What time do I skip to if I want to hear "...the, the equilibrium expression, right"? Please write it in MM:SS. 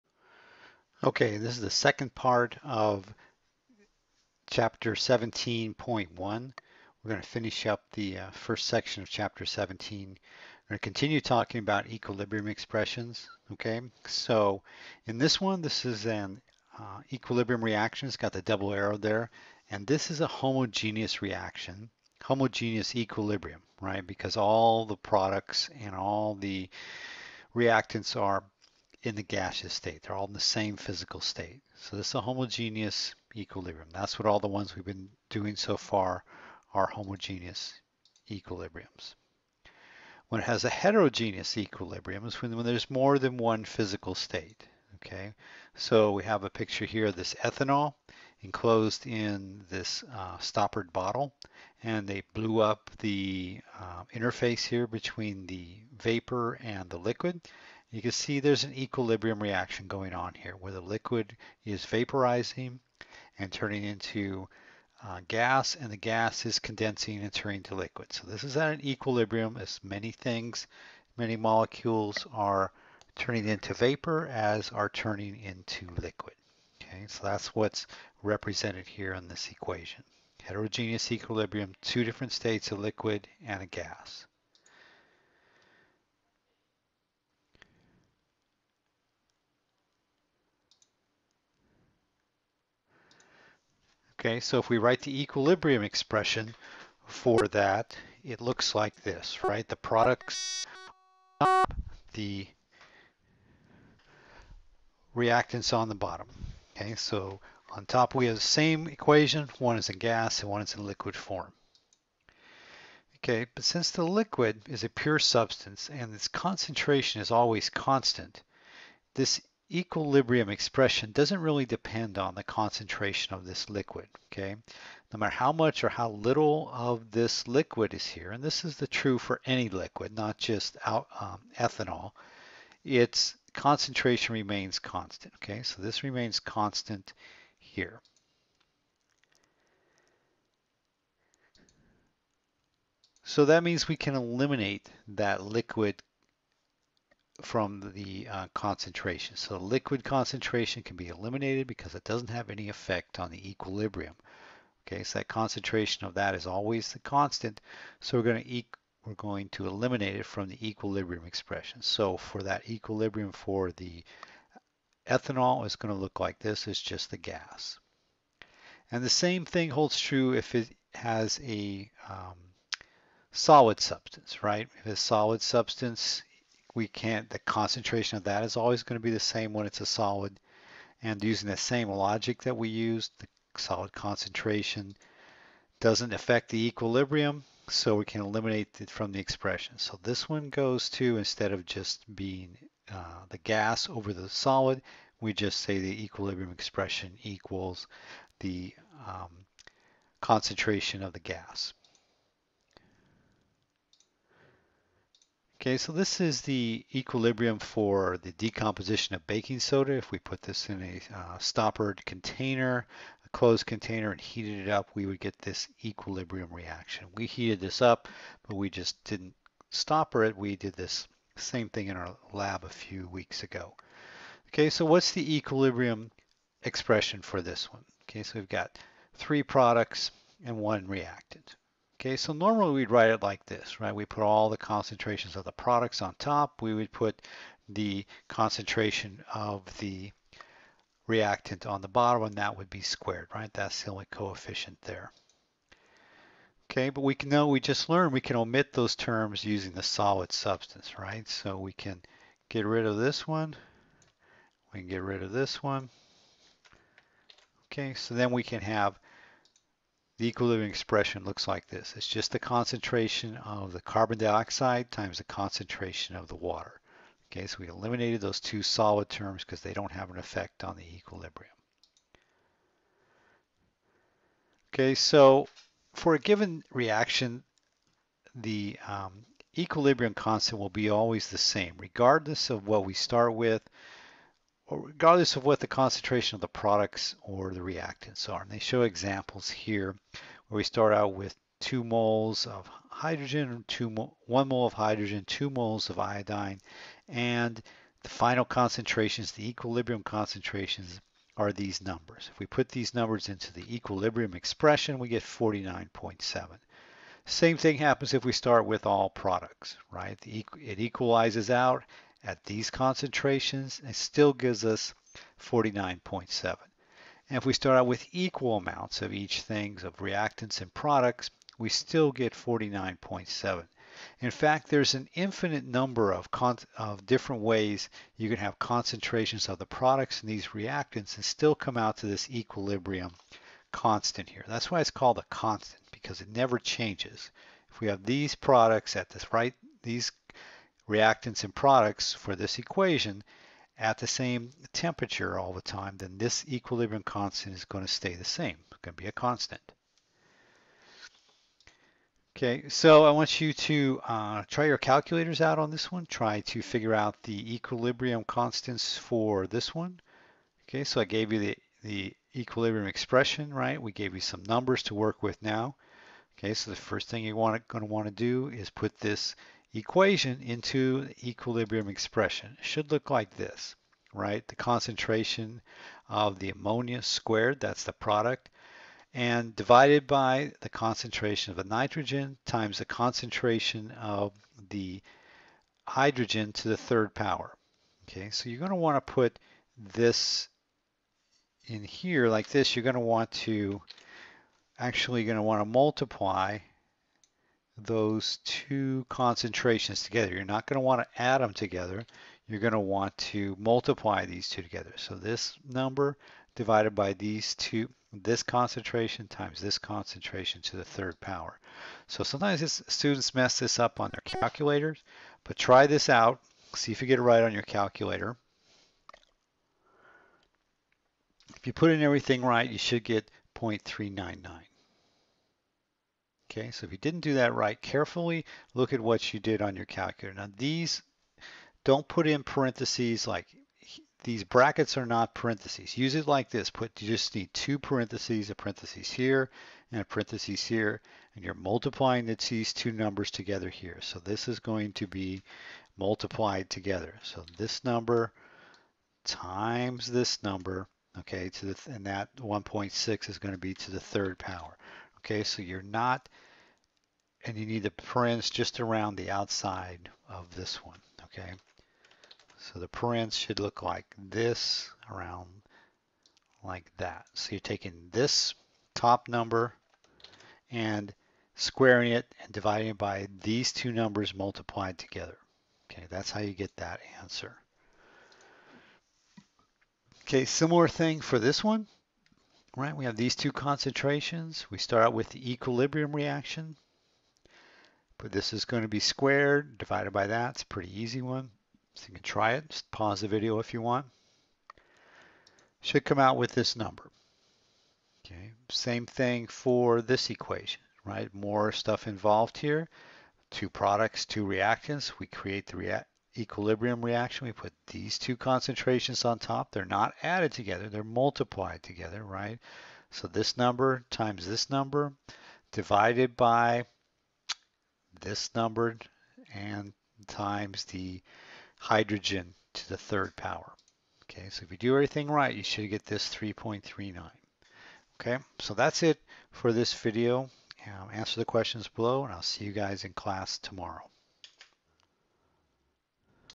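06:01.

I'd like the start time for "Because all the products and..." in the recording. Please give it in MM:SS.
00:24.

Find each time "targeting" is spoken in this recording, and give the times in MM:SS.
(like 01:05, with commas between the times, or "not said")
not said.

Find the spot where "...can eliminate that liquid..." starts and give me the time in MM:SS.
02:23.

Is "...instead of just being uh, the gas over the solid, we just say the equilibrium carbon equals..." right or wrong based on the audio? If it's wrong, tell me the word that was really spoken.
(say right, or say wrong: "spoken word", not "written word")
wrong: "expression", not "carbon".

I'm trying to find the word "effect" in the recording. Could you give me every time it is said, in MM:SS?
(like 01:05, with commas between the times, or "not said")
02:32, 04:30.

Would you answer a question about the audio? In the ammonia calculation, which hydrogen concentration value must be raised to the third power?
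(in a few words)
1.6.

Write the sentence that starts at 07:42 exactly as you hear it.
So the parens should look like this around like that.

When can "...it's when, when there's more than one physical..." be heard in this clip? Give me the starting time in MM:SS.
00:42.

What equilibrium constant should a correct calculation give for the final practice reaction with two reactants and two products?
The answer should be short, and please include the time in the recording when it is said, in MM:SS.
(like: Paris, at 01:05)
3.39, at 08:46.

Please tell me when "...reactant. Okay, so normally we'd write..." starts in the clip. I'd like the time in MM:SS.
03:50.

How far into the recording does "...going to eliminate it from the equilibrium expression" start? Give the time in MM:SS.
02:39.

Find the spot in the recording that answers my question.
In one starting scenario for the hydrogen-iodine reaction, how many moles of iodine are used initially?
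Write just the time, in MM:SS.
04:55.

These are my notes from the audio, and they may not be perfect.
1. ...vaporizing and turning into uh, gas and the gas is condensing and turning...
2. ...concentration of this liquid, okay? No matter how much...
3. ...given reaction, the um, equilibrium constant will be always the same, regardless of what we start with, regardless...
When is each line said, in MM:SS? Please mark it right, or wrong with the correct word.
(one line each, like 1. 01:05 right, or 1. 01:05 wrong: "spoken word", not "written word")
1. 01:01 right
2. 02:02 right
3. 04:36 right.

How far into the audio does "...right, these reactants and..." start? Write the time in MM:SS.
05:39.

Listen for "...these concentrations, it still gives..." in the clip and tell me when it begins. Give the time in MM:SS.
05:12.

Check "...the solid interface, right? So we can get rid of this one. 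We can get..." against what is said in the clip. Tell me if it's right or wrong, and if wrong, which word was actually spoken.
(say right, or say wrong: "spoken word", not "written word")
wrong: "substance", not "interface".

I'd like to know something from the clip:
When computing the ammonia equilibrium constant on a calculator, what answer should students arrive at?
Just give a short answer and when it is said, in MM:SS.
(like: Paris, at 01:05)
0.399, at 07:03.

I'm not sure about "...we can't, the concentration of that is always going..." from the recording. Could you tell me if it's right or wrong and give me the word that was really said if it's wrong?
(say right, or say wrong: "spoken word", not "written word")
right.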